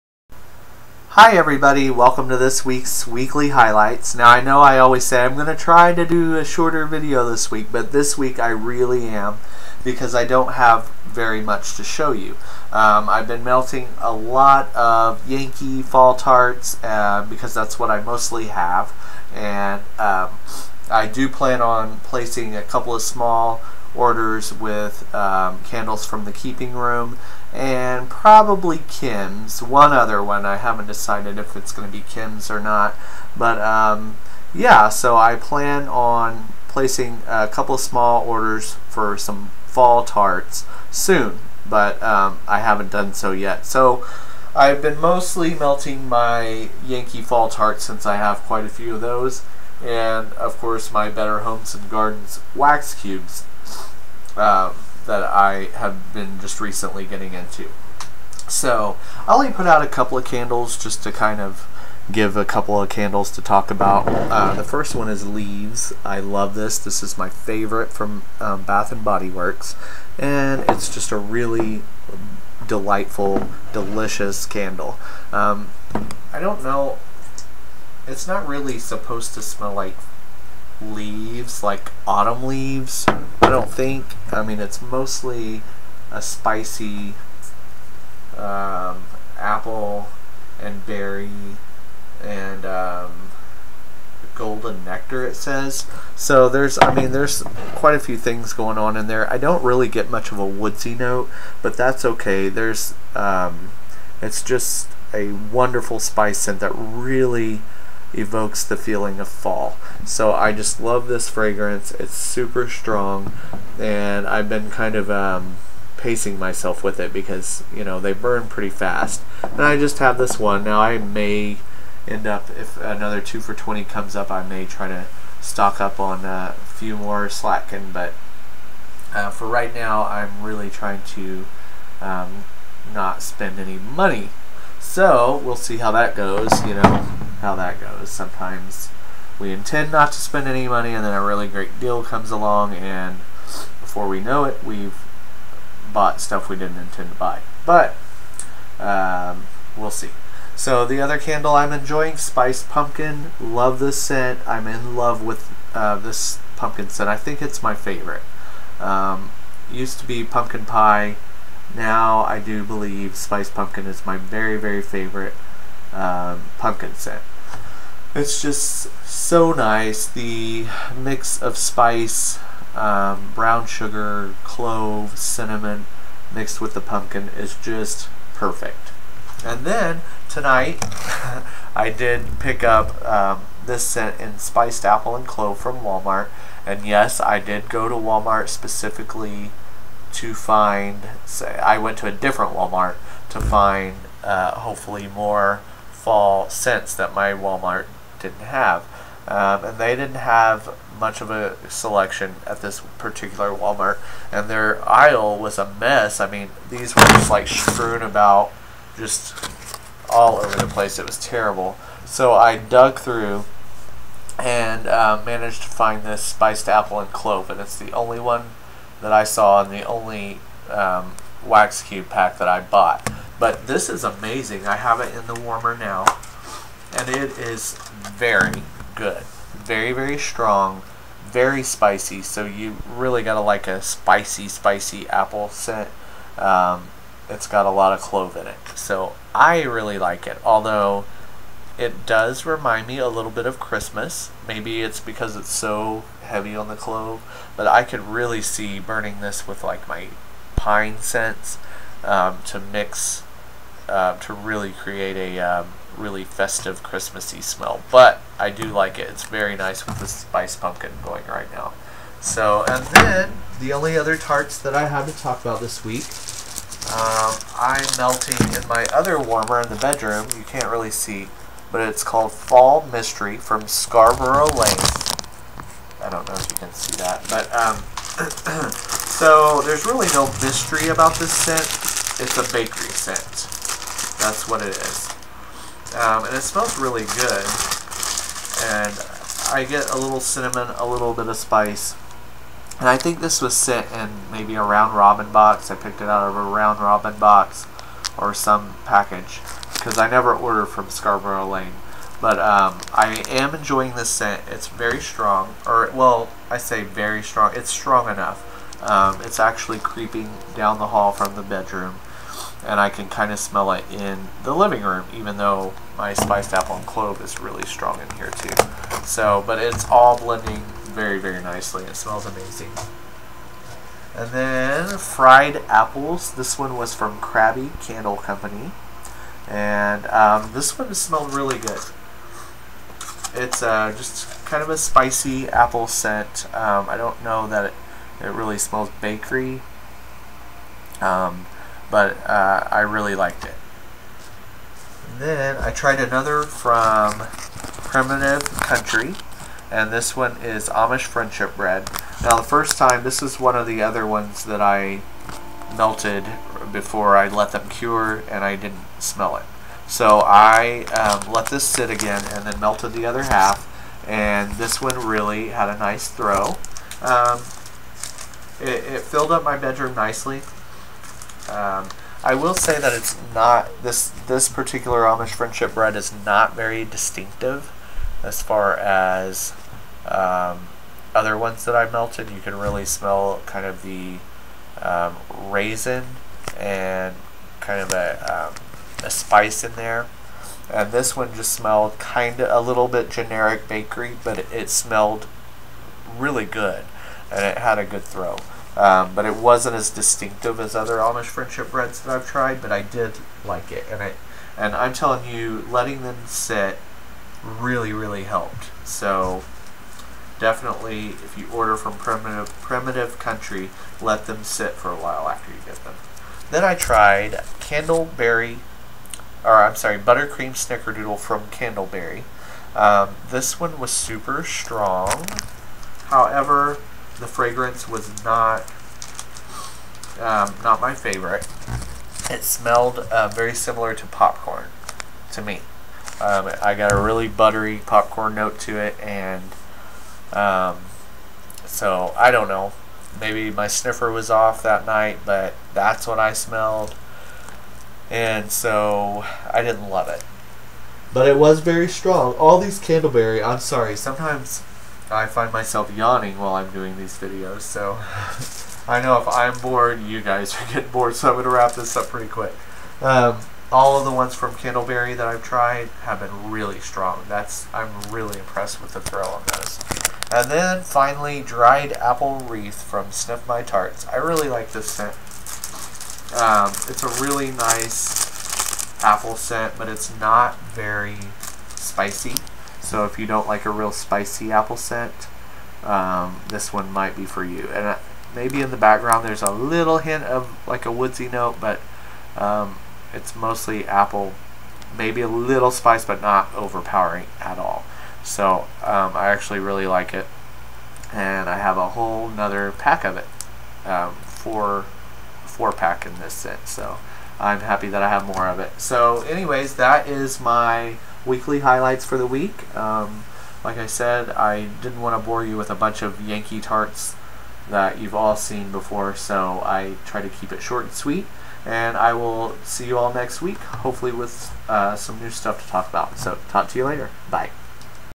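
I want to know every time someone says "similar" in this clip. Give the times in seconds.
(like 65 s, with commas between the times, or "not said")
433 s.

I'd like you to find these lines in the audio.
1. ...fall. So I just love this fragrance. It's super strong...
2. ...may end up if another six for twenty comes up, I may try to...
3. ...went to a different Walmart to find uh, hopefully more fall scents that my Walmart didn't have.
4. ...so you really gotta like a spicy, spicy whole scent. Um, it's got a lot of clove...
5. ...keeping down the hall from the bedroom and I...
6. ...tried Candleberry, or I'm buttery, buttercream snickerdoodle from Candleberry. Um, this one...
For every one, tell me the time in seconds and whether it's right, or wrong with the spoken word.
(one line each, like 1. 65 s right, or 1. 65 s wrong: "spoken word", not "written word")
1. 109 s right
2. 120 s wrong: "two", not "six"
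3. 191 s right
4. 232 s wrong: "apple", not "whole"
5. 309 s wrong: "creeping", not "keeping"
6. 416 s wrong: "sorry", not "buttery".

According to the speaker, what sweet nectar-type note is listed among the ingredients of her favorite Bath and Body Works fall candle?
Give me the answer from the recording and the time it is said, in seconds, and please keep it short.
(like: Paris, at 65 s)
golden nectar, at 94 s.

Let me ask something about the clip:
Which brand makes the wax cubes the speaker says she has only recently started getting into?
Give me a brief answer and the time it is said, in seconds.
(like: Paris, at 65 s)
Better Homes and Gardens, at 51 s.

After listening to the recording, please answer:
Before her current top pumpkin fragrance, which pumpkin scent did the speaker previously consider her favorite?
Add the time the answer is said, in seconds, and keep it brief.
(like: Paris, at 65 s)
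Pumpkin Pie, at 160 s.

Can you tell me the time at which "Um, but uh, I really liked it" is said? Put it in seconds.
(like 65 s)
340 s.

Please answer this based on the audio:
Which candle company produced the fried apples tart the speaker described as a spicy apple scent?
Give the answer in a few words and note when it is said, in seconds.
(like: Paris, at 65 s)
Krabby Candle Company, at 327 s.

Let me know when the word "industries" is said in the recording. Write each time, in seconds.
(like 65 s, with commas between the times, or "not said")
not said.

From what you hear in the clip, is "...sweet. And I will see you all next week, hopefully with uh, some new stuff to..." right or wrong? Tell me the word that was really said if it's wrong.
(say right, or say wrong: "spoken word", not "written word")
right.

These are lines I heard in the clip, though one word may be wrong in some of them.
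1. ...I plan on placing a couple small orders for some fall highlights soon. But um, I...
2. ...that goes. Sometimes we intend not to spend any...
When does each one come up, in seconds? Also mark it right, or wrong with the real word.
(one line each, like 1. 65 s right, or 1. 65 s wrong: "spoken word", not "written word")
1. 35 s wrong: "tarts", not "highlights"
2. 137 s right.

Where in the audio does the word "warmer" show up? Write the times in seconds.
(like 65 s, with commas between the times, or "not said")
225 s, 269 s.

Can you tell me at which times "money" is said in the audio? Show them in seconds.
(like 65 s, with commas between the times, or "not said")
133 s, 140 s.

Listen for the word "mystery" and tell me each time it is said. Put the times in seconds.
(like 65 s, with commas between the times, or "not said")
272 s, 280 s.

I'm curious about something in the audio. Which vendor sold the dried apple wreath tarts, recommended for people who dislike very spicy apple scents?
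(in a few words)
Sniff My Tarts.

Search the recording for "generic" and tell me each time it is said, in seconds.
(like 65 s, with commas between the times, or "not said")
393 s.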